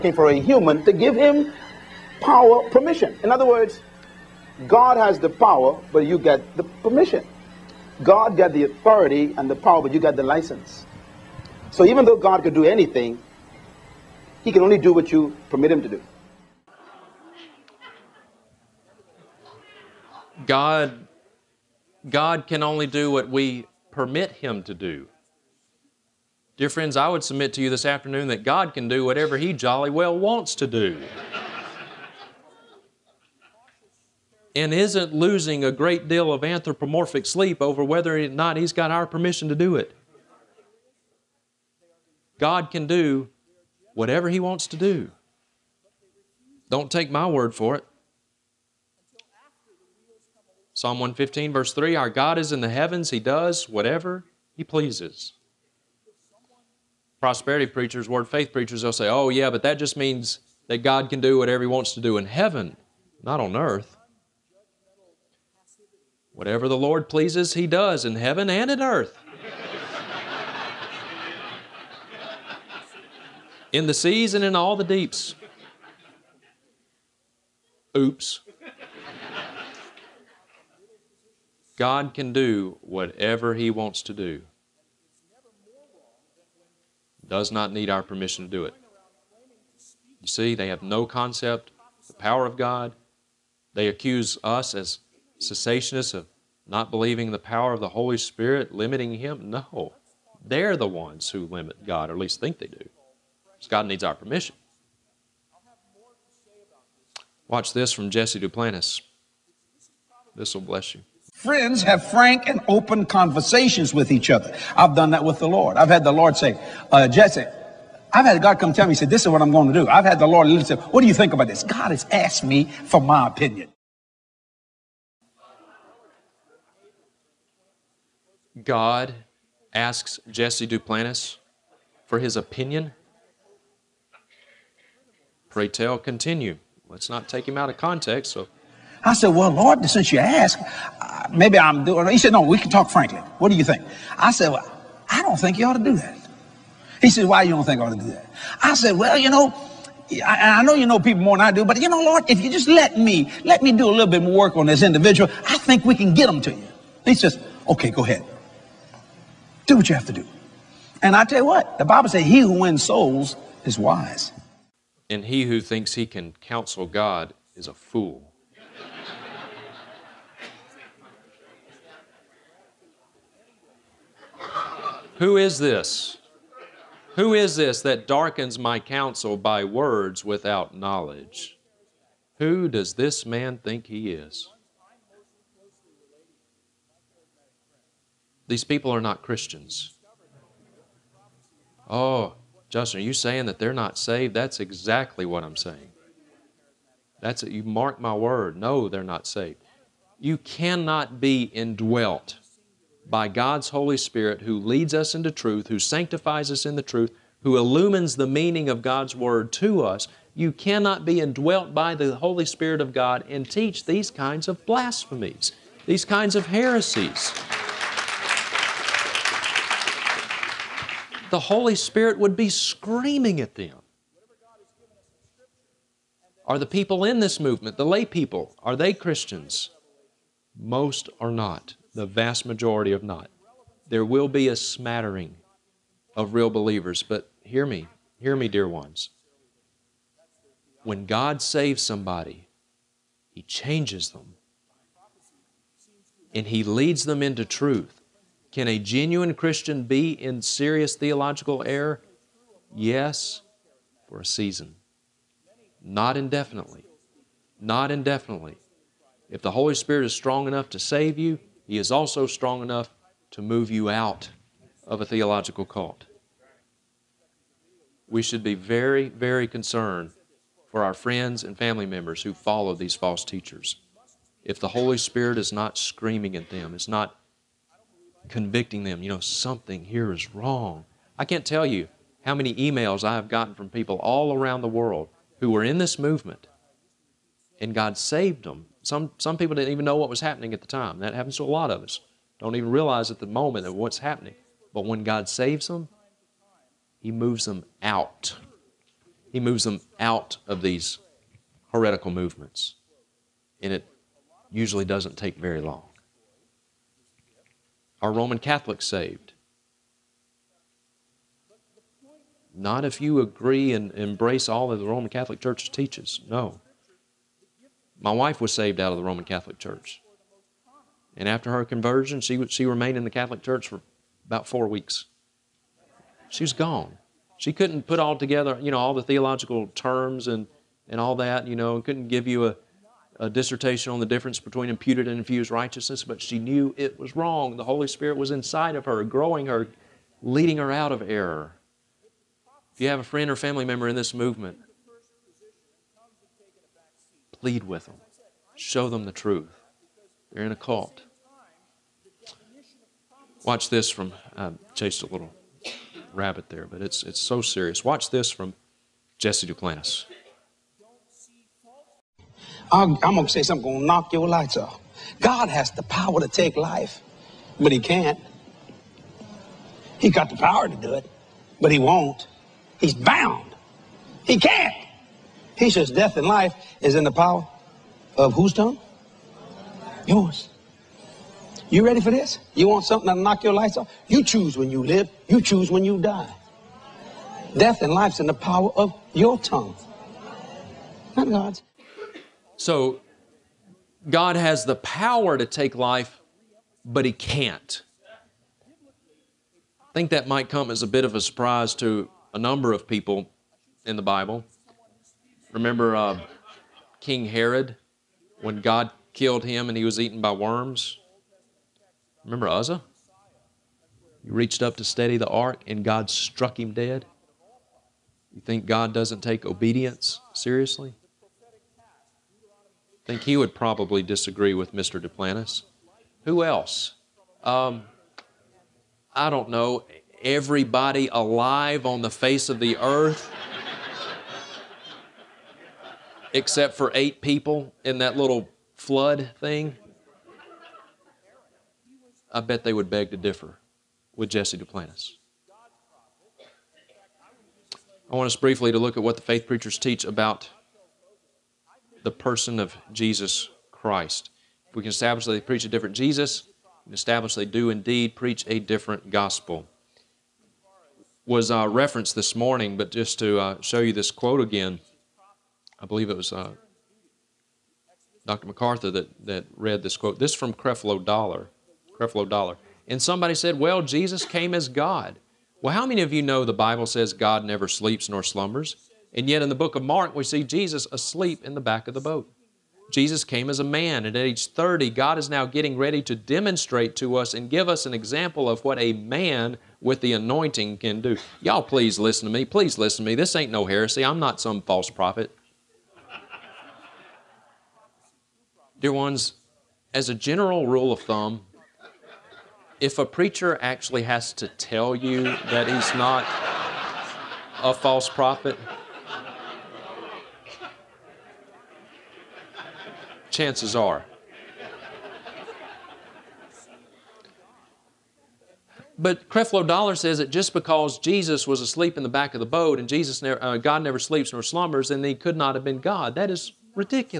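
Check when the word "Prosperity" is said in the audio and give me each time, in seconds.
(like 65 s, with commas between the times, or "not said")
57 s.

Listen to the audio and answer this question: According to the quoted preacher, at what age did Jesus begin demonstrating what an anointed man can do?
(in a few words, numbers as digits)
30.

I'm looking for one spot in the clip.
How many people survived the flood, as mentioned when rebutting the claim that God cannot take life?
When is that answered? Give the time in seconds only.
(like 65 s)
436 s.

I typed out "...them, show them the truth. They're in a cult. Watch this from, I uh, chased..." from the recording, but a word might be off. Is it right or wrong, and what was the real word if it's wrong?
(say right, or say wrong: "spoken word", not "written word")
right.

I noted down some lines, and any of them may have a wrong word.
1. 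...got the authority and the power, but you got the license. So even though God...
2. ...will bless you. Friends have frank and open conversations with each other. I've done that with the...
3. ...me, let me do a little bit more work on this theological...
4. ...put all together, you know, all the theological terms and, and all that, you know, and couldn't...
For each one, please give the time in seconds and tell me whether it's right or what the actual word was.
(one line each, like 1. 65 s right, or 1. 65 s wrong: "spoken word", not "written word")
1. 8 s right
2. 110 s right
3. 152 s wrong: "individual", not "theological"
4. 327 s right.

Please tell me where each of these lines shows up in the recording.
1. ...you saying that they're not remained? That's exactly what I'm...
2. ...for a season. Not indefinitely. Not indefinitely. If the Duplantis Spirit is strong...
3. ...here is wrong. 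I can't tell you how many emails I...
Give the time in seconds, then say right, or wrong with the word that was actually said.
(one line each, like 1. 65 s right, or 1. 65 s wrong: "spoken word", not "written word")
1. 193 s wrong: "saved", not "remained"
2. 254 s wrong: "Holy", not "Duplantis"
3. 279 s right.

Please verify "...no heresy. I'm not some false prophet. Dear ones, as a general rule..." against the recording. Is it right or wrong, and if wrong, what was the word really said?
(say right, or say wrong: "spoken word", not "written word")
right.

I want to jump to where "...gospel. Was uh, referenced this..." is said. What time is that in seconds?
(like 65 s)
459 s.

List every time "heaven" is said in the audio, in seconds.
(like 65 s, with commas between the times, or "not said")
52 s, 62 s, 68 s.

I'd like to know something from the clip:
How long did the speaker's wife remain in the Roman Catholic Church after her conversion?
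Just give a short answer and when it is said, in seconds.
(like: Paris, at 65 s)
About four weeks, at 324 s.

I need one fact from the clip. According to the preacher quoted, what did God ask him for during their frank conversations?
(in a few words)
His opinion.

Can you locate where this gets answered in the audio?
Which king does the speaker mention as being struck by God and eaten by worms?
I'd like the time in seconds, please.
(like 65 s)
406 s.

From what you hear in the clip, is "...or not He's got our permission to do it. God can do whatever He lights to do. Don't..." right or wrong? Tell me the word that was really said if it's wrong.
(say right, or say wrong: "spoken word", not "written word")
wrong: "wants", not "lights".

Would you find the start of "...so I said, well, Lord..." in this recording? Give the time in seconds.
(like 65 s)
138 s.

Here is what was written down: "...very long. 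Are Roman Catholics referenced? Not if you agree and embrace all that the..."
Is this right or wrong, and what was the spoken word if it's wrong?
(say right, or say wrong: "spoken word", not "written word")
wrong: "saved", not "referenced".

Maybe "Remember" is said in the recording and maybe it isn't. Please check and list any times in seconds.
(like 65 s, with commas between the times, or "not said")
405 s, 412 s.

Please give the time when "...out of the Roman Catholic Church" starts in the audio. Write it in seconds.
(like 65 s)
318 s.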